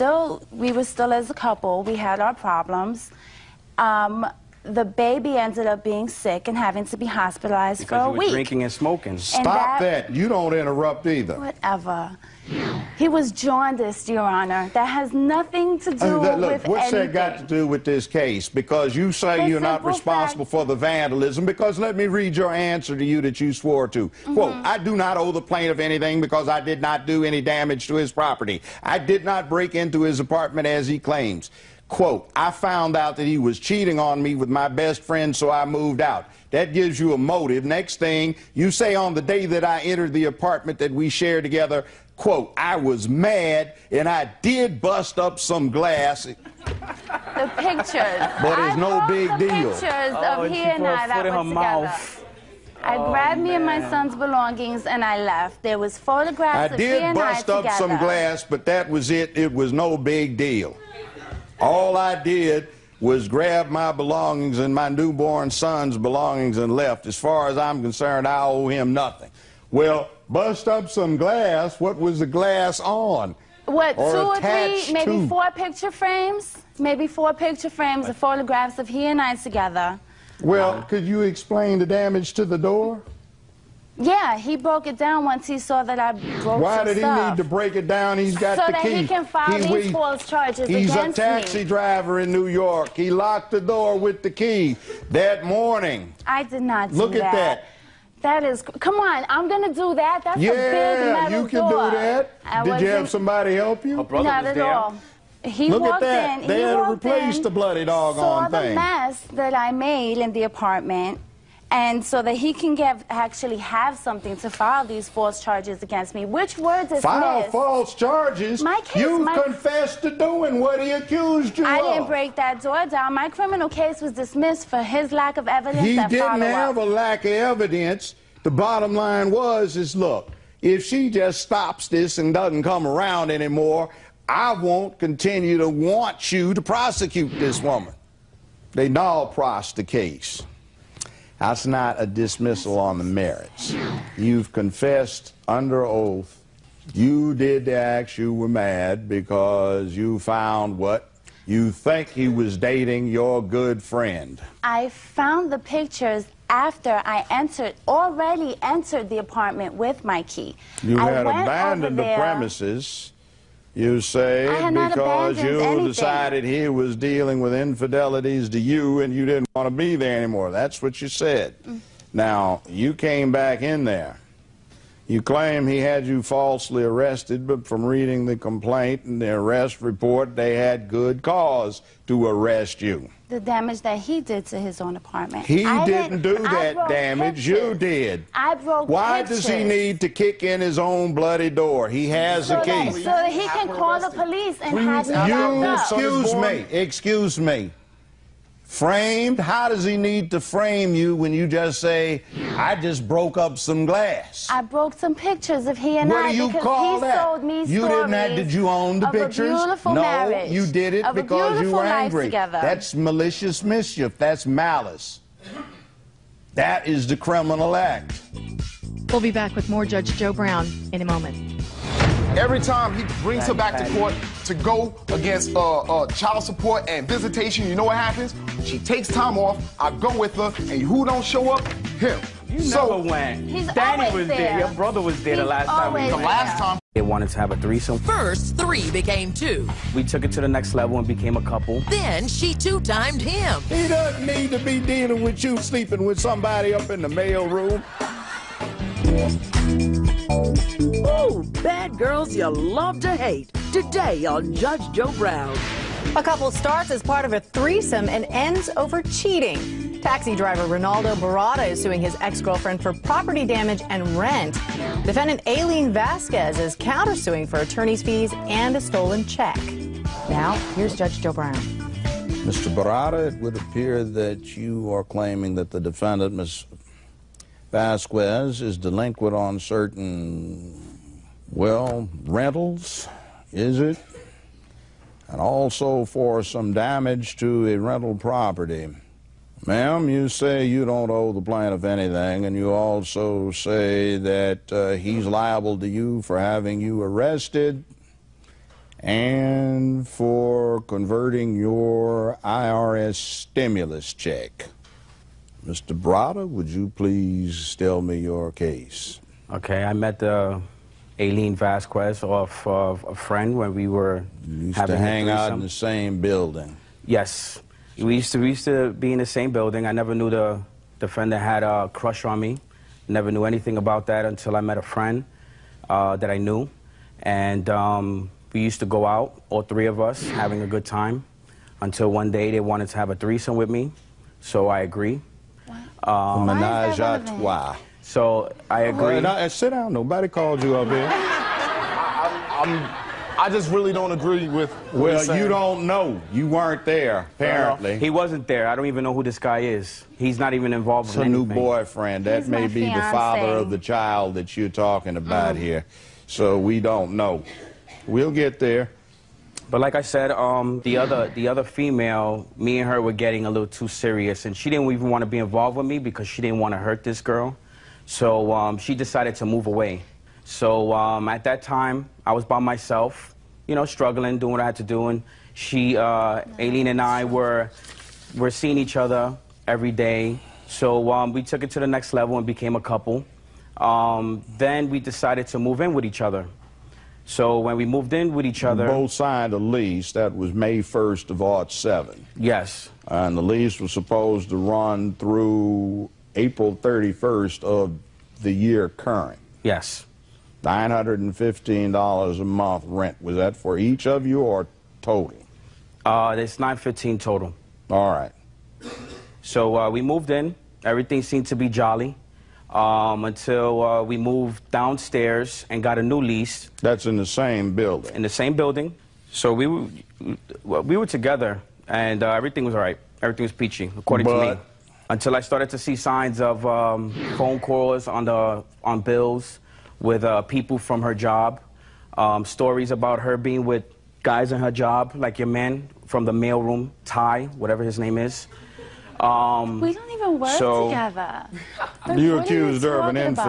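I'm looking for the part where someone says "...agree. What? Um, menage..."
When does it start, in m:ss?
5:34.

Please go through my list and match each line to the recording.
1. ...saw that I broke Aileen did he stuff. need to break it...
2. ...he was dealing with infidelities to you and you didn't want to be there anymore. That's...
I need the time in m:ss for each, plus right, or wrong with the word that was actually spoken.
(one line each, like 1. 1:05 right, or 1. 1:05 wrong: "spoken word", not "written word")
1. 1:25 wrong: "Why", not "Aileen"
2. 2:46 right.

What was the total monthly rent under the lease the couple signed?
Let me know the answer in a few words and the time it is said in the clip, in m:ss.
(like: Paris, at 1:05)
$915, at 6:40.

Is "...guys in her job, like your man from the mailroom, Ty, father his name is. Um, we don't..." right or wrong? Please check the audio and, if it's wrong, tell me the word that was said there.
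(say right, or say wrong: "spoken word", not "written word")
wrong: "whatever", not "father".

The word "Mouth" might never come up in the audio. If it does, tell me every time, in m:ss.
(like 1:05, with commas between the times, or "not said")
0:51.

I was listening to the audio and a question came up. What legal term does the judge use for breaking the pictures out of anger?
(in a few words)
Malicious mischief.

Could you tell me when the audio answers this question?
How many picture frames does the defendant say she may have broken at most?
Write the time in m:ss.
1:16.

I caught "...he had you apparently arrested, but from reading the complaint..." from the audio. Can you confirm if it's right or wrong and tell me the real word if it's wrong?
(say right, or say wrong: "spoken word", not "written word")
wrong: "falsely", not "apparently".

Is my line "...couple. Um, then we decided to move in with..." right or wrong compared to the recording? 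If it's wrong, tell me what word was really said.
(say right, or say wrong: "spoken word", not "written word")
right.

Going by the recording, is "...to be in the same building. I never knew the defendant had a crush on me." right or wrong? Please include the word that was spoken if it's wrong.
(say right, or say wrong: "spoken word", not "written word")
right.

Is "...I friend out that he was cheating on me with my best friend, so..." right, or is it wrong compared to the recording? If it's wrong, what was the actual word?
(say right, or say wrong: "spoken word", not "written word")
wrong: "found", not "friend".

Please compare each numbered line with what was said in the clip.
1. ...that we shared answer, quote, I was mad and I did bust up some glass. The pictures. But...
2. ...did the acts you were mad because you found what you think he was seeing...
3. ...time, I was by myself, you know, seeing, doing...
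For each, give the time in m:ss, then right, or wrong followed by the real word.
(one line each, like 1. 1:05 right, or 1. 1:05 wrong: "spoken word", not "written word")
1. 0:40 wrong: "together", not "answer"
2. 2:27 wrong: "dating", not "seeing"
3. 6:11 wrong: "struggling", not "seeing".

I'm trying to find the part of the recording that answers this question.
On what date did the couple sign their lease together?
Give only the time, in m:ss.
6:30.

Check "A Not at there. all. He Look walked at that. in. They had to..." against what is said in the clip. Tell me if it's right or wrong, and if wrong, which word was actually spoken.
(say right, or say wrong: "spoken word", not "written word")
right.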